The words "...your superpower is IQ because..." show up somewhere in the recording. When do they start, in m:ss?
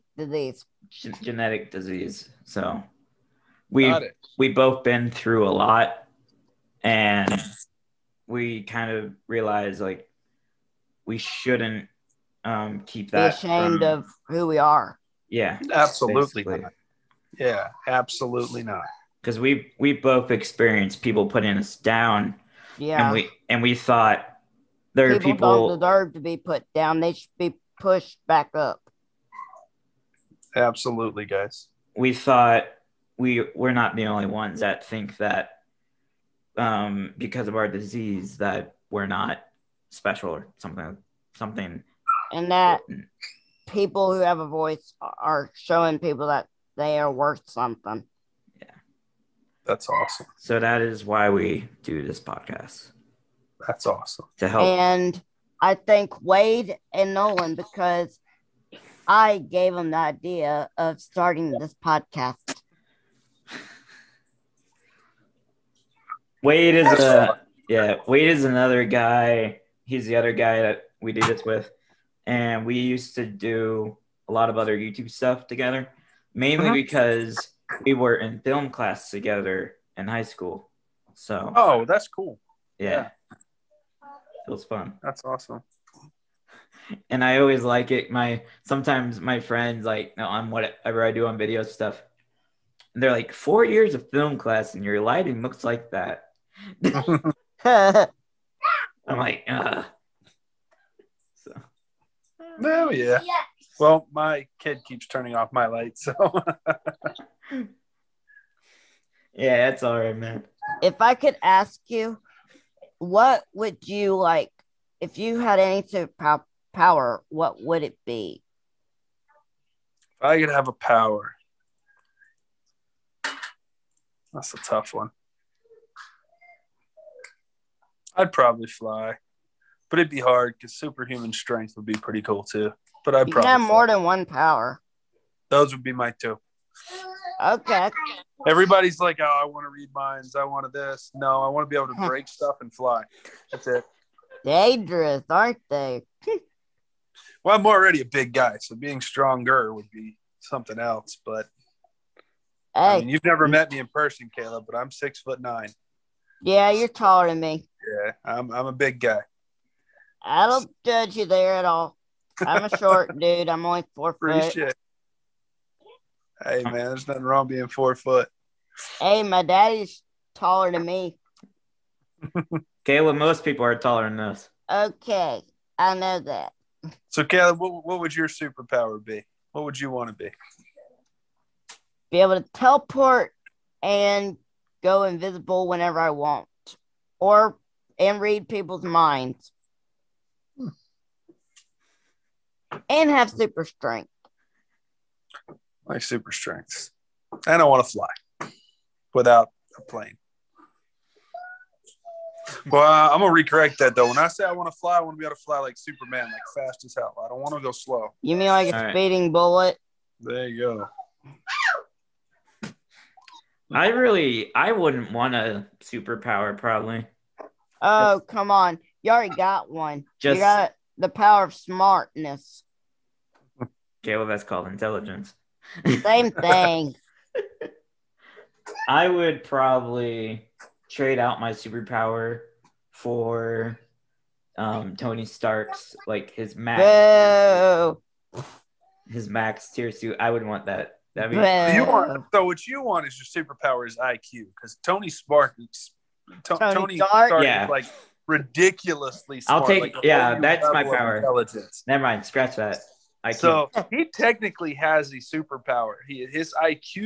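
4:03.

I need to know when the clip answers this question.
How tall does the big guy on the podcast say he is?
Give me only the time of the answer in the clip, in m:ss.
2:34.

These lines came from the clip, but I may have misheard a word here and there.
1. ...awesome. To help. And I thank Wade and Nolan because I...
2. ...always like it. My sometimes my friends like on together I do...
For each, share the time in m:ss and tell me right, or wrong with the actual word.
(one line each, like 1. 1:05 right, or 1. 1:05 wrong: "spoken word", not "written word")
1. 0:53 right
2. 1:27 wrong: "whatever", not "together".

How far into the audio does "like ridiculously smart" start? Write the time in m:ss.
4:07.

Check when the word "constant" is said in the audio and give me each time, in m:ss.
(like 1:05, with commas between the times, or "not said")
not said.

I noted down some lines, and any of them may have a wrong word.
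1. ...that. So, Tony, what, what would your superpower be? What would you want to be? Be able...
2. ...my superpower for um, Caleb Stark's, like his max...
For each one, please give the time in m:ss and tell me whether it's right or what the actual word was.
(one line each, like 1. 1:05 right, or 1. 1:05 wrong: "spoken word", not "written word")
1. 2:56 wrong: "Caleb", not "Tony"
2. 3:51 wrong: "Tony", not "Caleb".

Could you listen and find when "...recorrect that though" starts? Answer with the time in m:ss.
3:23.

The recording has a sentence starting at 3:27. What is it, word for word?
I don't want to go slow.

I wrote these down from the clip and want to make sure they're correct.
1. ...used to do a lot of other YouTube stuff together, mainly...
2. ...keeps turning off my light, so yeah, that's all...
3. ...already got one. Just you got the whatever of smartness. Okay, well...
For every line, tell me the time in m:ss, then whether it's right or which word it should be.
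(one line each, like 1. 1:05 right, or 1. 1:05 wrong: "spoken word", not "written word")
1. 1:12 right
2. 1:44 right
3. 3:39 wrong: "power", not "whatever".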